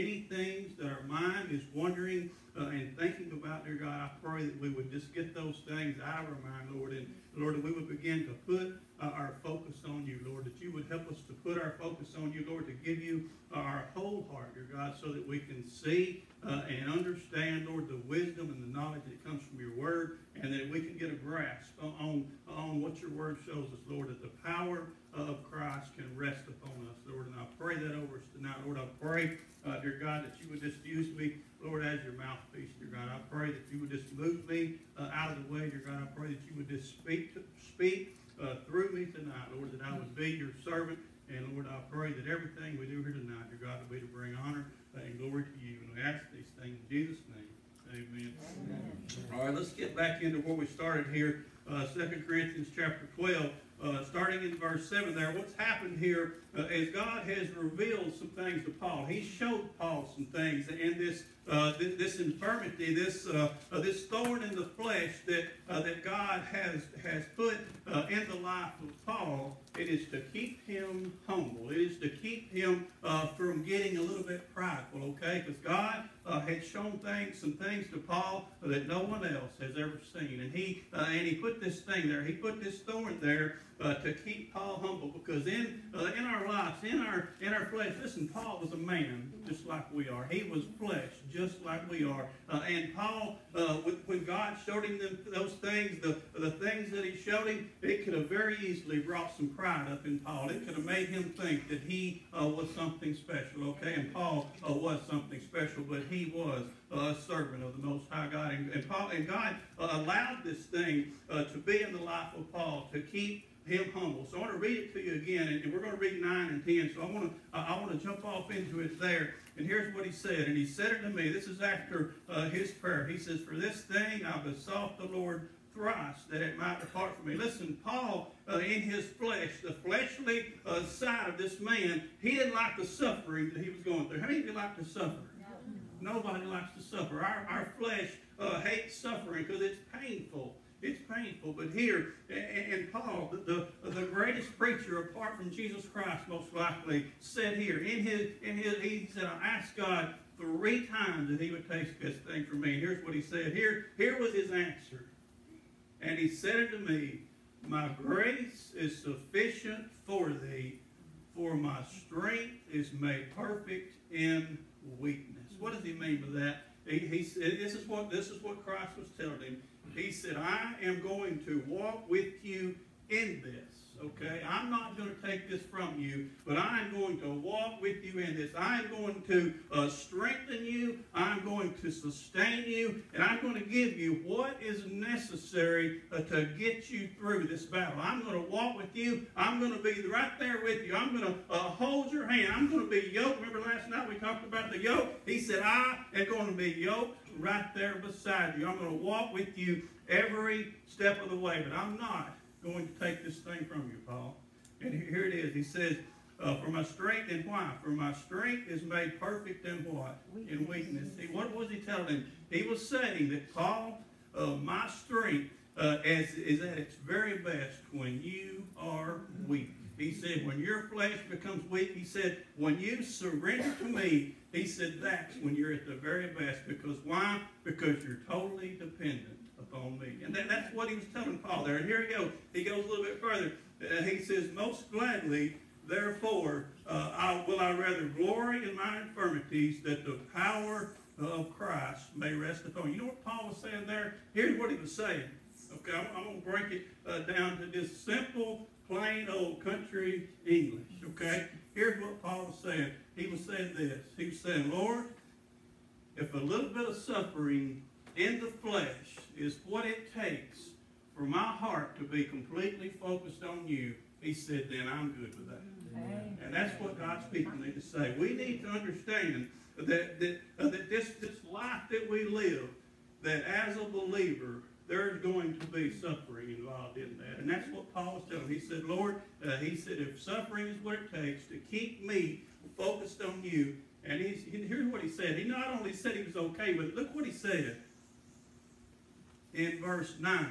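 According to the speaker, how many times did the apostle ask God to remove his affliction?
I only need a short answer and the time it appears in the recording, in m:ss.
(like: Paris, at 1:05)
3, at 2:30.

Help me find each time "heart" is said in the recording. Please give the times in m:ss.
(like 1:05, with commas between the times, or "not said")
0:14, 4:21.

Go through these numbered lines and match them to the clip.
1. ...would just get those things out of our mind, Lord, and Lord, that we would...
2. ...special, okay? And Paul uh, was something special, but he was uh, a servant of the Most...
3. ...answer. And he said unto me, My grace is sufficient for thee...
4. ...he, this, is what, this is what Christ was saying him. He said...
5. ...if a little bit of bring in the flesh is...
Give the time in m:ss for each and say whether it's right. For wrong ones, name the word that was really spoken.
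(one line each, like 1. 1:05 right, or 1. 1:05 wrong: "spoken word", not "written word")
1. 0:04 right
2. 1:43 right
3. 2:34 right
4. 2:46 wrong: "telling", not "saying"
5. 4:16 wrong: "suffering", not "bring".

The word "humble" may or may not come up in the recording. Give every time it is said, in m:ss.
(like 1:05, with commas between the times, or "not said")
1:11, 1:24, 1:53.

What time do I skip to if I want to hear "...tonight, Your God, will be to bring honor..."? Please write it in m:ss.
0:43.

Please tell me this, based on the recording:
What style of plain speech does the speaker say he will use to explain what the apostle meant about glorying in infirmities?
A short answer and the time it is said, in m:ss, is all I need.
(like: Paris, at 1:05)
Plain old country English, at 4:08.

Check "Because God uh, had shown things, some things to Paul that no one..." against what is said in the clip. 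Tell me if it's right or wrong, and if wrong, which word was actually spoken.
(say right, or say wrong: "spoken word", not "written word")
right.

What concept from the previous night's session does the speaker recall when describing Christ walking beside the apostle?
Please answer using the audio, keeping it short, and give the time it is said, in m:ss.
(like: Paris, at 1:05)
The yoke, at 3:14.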